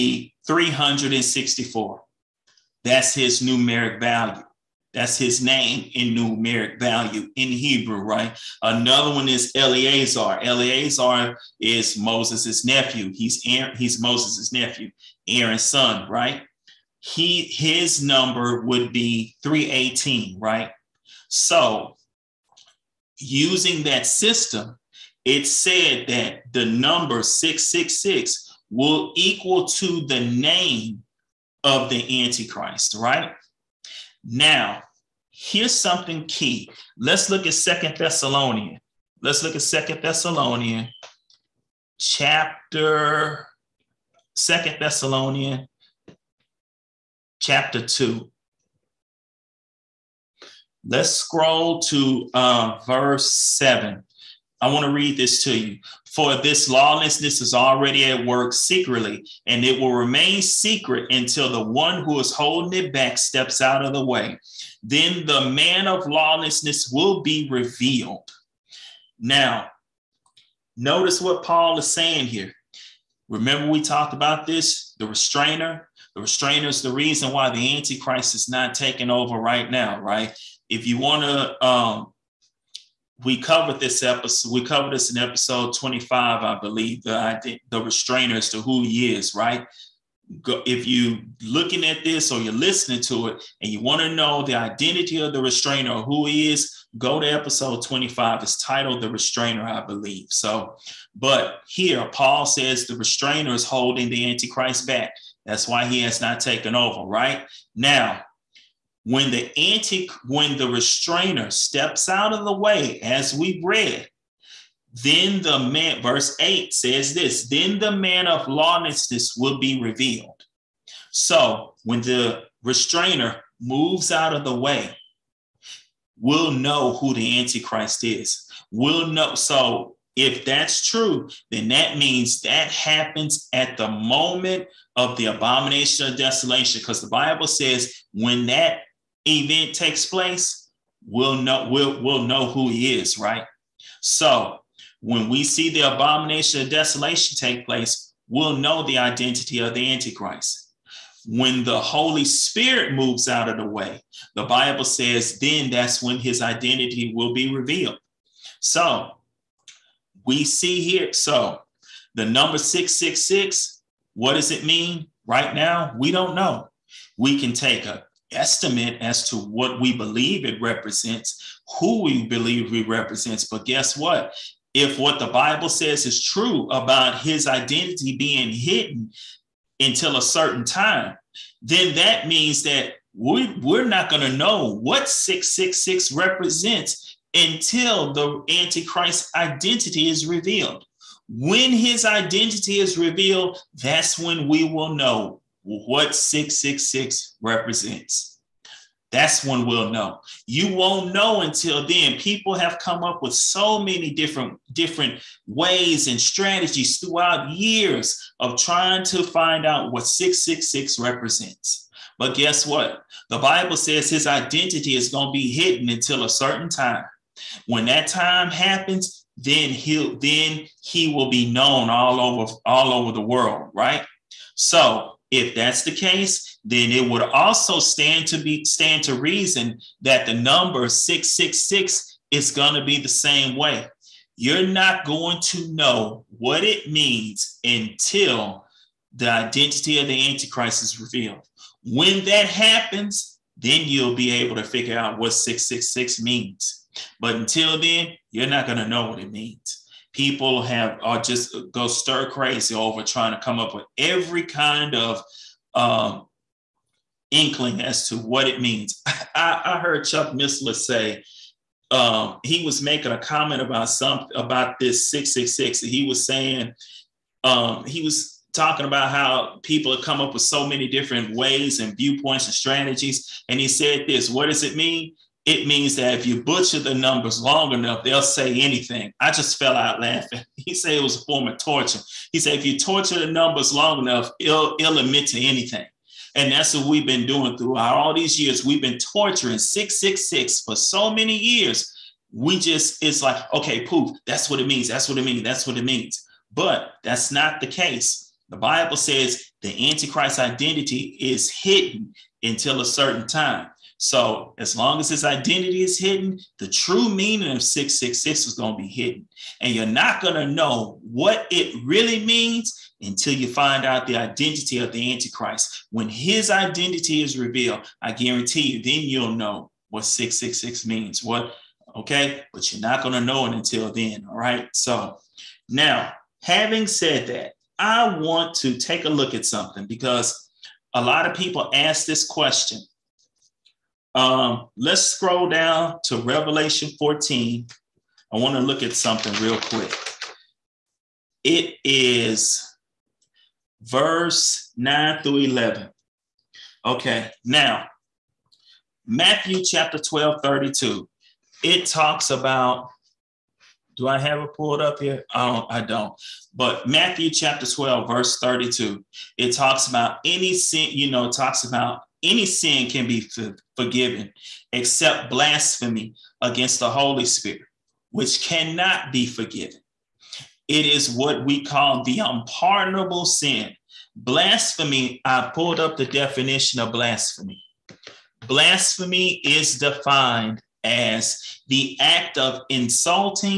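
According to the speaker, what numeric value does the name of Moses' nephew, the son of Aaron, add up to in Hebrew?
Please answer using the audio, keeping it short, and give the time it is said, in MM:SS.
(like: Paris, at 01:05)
318, at 00:19.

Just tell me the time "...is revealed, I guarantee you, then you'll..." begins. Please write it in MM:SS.
05:17.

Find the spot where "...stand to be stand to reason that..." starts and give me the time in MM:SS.
03:47.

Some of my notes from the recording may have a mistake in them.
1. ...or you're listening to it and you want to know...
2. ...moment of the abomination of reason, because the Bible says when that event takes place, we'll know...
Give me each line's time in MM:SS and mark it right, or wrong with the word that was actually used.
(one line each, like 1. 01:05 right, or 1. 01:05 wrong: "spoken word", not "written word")
1. 01:32 right
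2. 02:13 wrong: "desolation", not "reason".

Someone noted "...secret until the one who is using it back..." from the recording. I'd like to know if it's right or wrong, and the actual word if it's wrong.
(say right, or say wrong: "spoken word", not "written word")
wrong: "holding", not "using".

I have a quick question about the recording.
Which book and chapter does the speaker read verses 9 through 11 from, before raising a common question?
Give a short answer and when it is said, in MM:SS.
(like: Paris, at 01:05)
Revelation 14, at 05:36.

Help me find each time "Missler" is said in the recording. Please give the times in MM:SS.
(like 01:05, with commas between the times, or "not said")
04:20.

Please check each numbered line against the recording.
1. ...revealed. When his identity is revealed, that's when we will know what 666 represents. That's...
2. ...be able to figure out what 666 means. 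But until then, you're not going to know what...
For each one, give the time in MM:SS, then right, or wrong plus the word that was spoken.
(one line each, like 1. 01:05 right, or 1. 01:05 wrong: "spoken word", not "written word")
1. 03:10 right
2. 04:04 right.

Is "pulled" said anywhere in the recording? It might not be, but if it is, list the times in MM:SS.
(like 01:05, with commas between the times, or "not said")
05:54, 06:15.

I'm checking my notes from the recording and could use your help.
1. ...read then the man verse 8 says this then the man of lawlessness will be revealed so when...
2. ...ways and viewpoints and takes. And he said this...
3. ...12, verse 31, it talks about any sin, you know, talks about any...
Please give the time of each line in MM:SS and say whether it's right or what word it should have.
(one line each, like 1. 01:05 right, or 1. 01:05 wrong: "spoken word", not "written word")
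1. 01:53 right
2. 04:31 wrong: "strategies", not "takes"
3. 05:57 wrong: "32", not "31".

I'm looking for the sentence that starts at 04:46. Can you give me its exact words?
And that's what we've been doing throughout all these years.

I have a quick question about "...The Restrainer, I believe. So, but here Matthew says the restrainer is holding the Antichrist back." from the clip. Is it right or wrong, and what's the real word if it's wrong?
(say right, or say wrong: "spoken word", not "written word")
wrong: "Paul", not "Matthew".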